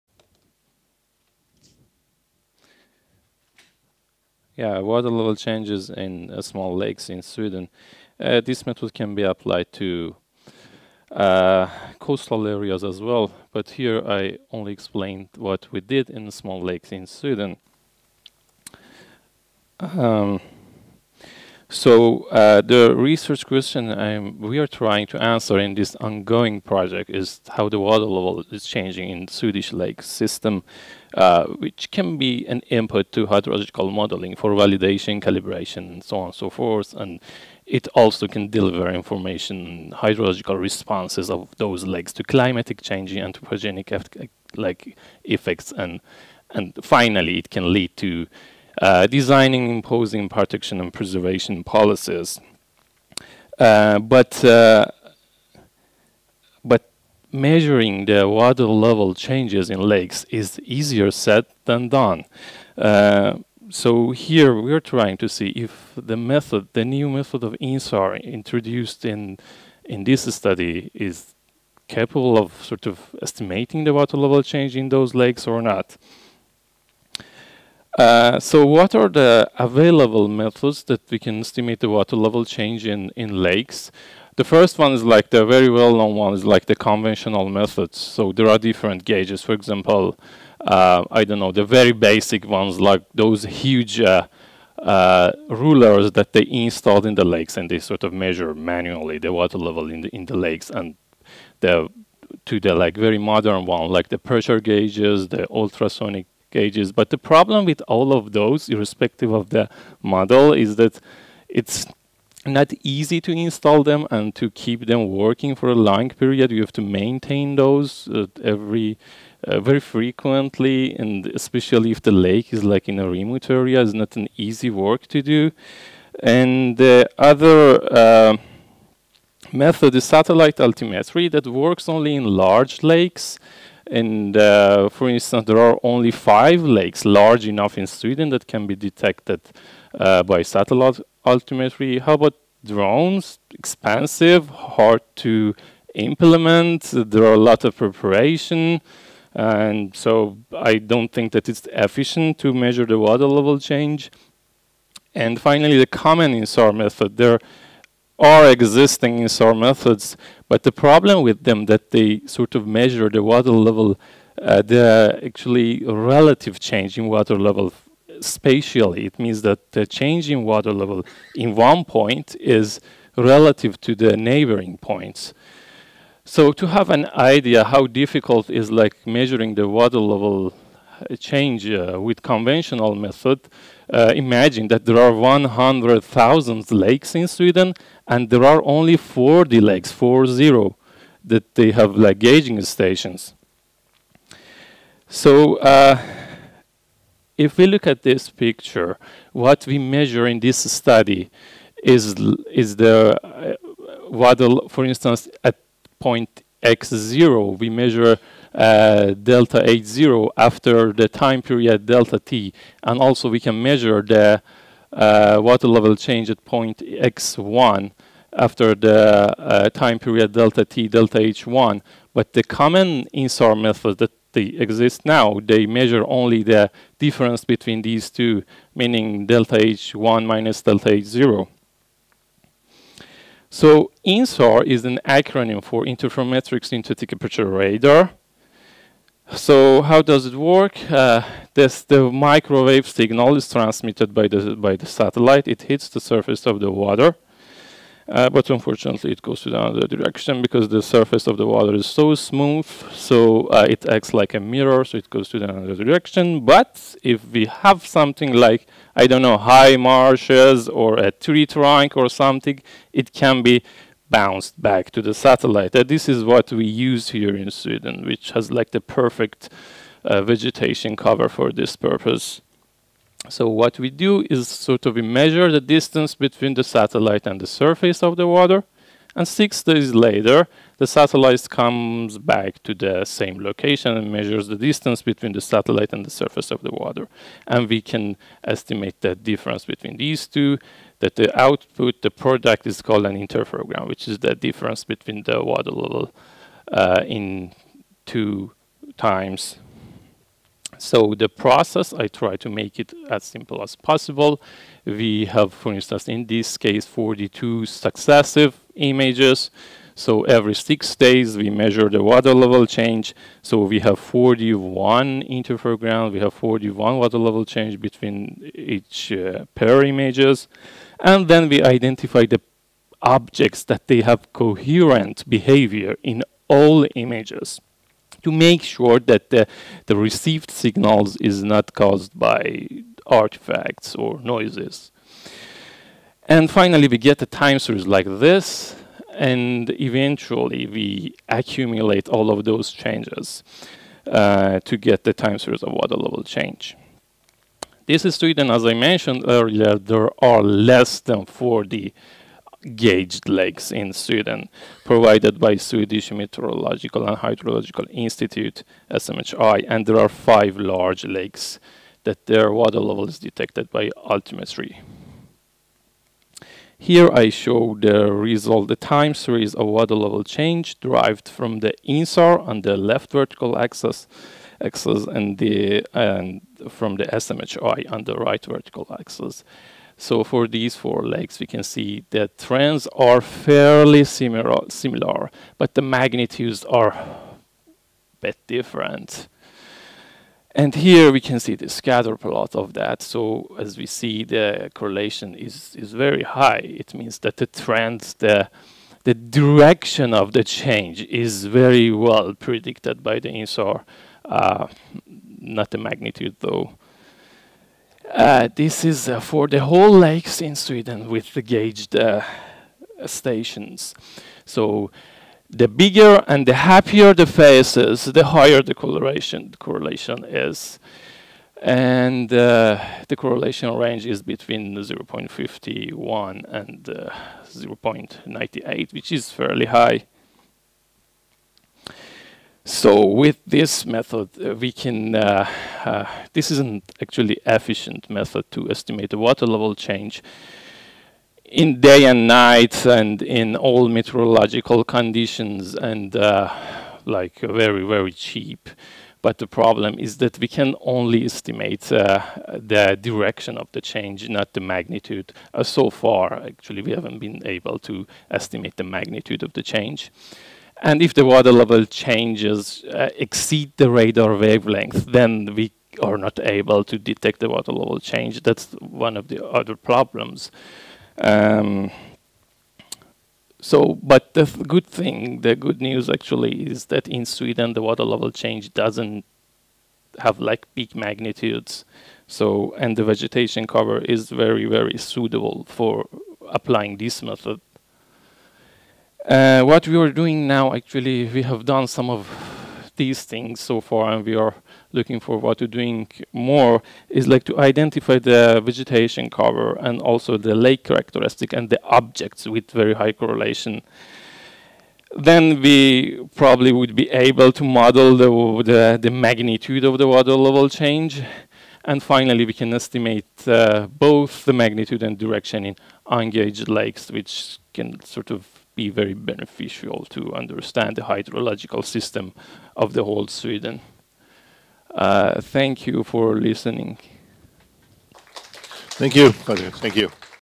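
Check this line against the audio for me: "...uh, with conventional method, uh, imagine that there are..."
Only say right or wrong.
right.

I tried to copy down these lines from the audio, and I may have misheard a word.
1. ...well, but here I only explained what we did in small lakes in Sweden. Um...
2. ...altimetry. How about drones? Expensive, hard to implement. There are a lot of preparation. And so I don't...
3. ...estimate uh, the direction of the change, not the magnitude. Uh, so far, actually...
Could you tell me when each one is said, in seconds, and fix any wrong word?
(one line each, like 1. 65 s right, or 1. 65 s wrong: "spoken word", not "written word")
1. 13 s right
2. 141 s right
3. 451 s right.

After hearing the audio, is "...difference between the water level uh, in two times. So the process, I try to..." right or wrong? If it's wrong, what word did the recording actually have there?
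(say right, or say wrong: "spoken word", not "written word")
right.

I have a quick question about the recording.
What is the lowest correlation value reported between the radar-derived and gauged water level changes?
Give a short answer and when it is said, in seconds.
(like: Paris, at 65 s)
0.51, at 424 s.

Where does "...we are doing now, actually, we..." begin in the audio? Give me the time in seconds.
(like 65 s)
489 s.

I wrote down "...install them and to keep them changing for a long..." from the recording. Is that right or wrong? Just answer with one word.
wrong.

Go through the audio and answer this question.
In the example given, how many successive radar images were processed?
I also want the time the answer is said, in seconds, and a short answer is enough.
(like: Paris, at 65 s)
42, at 306 s.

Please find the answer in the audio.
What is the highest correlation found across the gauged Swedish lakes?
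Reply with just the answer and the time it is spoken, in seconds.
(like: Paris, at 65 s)
0.98, at 427 s.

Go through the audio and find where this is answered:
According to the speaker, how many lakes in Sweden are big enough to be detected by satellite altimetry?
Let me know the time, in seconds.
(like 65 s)
136 s.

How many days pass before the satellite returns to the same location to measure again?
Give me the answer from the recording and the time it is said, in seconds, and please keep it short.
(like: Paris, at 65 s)
6 days, at 279 s.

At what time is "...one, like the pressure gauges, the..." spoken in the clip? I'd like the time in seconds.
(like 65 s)
103 s.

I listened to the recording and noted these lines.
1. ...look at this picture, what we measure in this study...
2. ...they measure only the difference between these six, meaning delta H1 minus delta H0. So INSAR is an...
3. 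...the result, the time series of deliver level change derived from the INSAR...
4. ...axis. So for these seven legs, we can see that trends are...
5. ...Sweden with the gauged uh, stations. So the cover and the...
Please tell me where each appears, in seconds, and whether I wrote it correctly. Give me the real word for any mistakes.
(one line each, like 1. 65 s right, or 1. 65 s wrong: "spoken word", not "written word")
1. 197 s right
2. 225 s wrong: "two", not "six"
3. 367 s wrong: "water", not "deliver"
4. 378 s wrong: "four", not "seven"
5. 410 s wrong: "bigger", not "cover".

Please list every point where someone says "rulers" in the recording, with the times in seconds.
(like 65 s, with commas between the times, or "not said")
95 s.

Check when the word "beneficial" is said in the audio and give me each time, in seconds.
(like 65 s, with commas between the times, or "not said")
519 s.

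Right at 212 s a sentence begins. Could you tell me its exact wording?
And also we can measure the uh, water level change at point X1 after the uh, time period delta T, delta H1.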